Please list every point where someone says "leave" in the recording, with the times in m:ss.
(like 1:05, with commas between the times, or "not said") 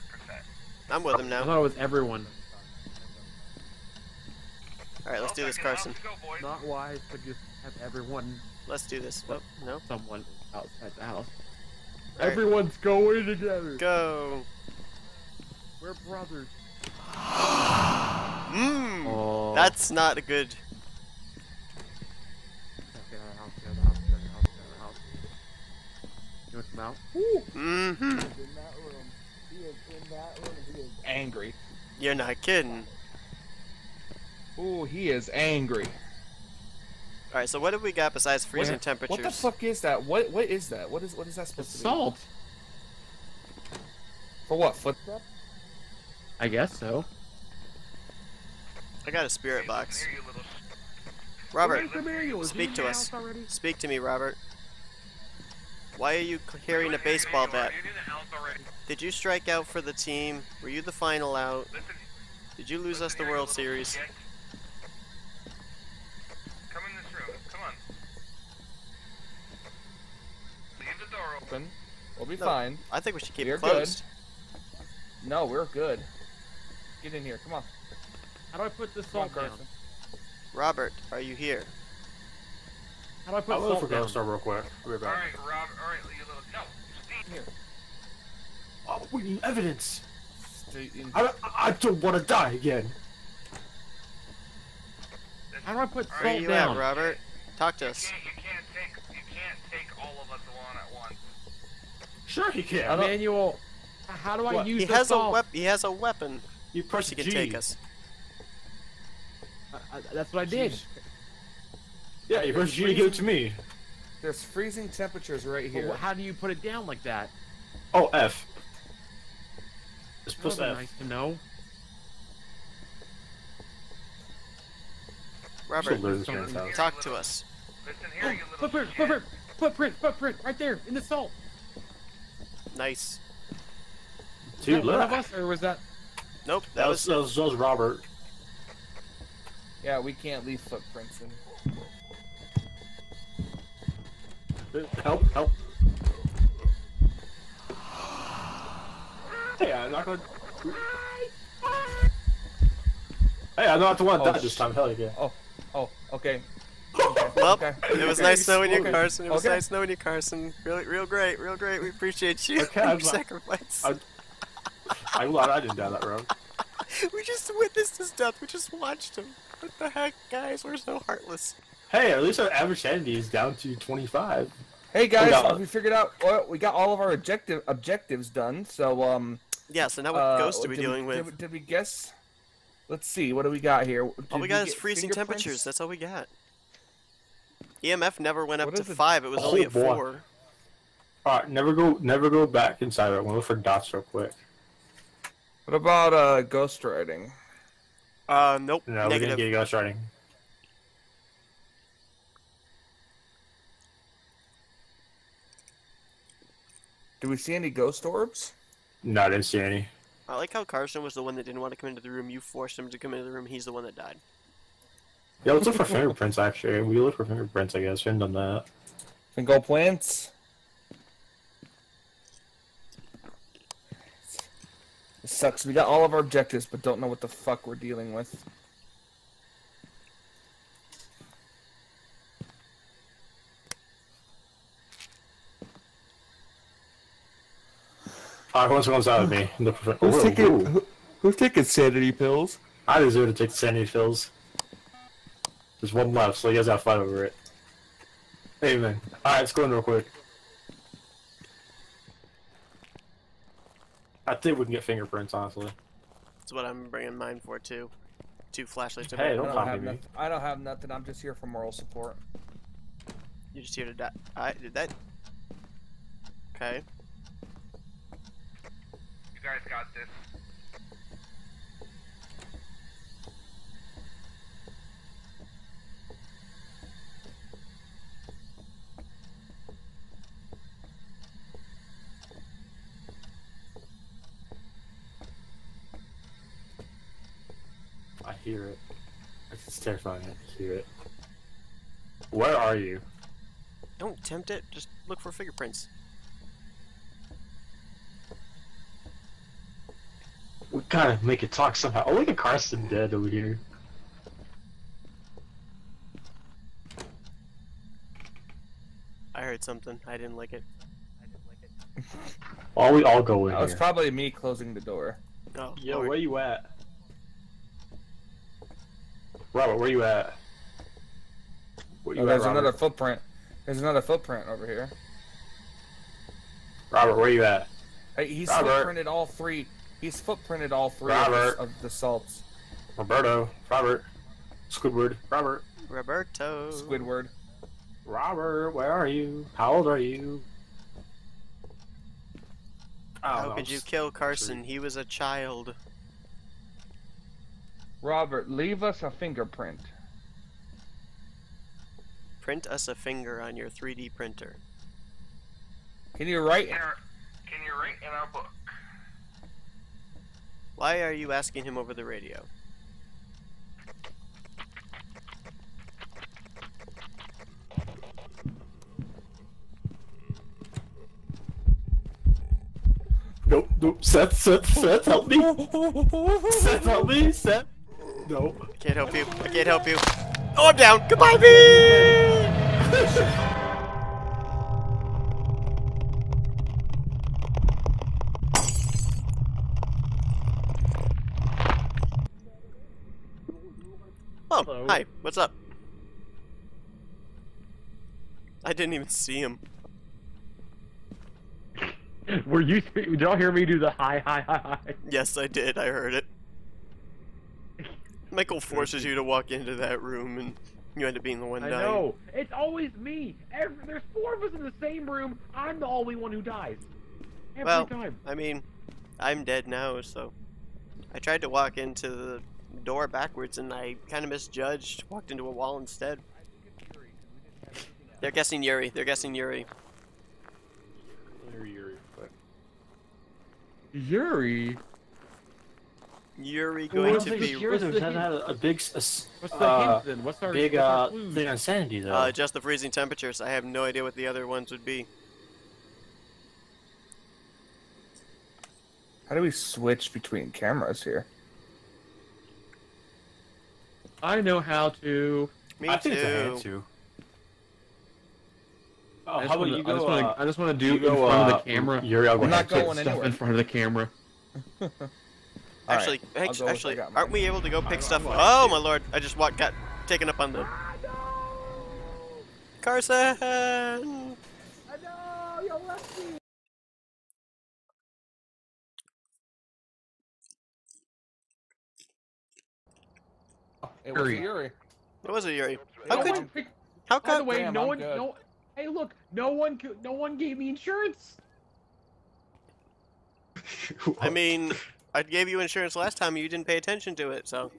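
1:10, 2:20, 5:48.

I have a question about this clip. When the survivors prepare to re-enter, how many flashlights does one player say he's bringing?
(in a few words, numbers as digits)
2.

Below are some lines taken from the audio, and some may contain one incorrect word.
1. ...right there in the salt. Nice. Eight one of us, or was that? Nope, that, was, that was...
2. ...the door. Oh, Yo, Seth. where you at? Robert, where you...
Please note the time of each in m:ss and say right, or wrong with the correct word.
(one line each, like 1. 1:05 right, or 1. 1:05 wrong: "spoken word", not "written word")
1. 2:10 wrong: "Two", not "Eight"
2. 5:14 wrong: "Lord", not "Seth".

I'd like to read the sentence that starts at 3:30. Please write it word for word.
I like how Karson was the one that didn't want to come into the room.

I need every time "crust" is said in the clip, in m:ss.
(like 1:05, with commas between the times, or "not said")
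not said.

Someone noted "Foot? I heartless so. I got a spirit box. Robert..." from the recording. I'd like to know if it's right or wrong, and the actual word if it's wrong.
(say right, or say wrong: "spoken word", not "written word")
wrong: "guess", not "heartless".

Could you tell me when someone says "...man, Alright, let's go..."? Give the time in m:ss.
4:08.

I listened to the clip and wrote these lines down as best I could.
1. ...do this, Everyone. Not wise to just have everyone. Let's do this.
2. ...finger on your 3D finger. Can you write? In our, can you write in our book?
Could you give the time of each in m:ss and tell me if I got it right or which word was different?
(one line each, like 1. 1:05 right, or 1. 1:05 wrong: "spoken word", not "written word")
1. 0:05 wrong: "Karson", not "Everyone"
2. 5:52 wrong: "printer", not "finger".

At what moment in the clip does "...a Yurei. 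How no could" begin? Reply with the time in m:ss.
8:05.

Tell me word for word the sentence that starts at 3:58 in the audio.
Alright, who wants to out with me?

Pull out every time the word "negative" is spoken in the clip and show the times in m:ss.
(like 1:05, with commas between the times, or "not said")
3:19.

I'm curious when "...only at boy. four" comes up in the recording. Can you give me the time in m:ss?
3:09.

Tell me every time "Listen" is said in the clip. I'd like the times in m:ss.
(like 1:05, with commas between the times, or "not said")
2:07.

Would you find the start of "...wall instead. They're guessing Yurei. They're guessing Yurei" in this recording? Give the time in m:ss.
7:05.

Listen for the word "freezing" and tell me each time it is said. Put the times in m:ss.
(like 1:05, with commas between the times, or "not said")
0:38, 1:54, 3:04, 7:22.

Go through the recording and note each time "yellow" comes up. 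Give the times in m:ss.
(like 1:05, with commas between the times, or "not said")
not said.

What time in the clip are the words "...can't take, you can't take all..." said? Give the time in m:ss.
1:38.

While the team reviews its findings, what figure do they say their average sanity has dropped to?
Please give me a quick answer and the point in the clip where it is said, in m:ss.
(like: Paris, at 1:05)
25, at 2:53.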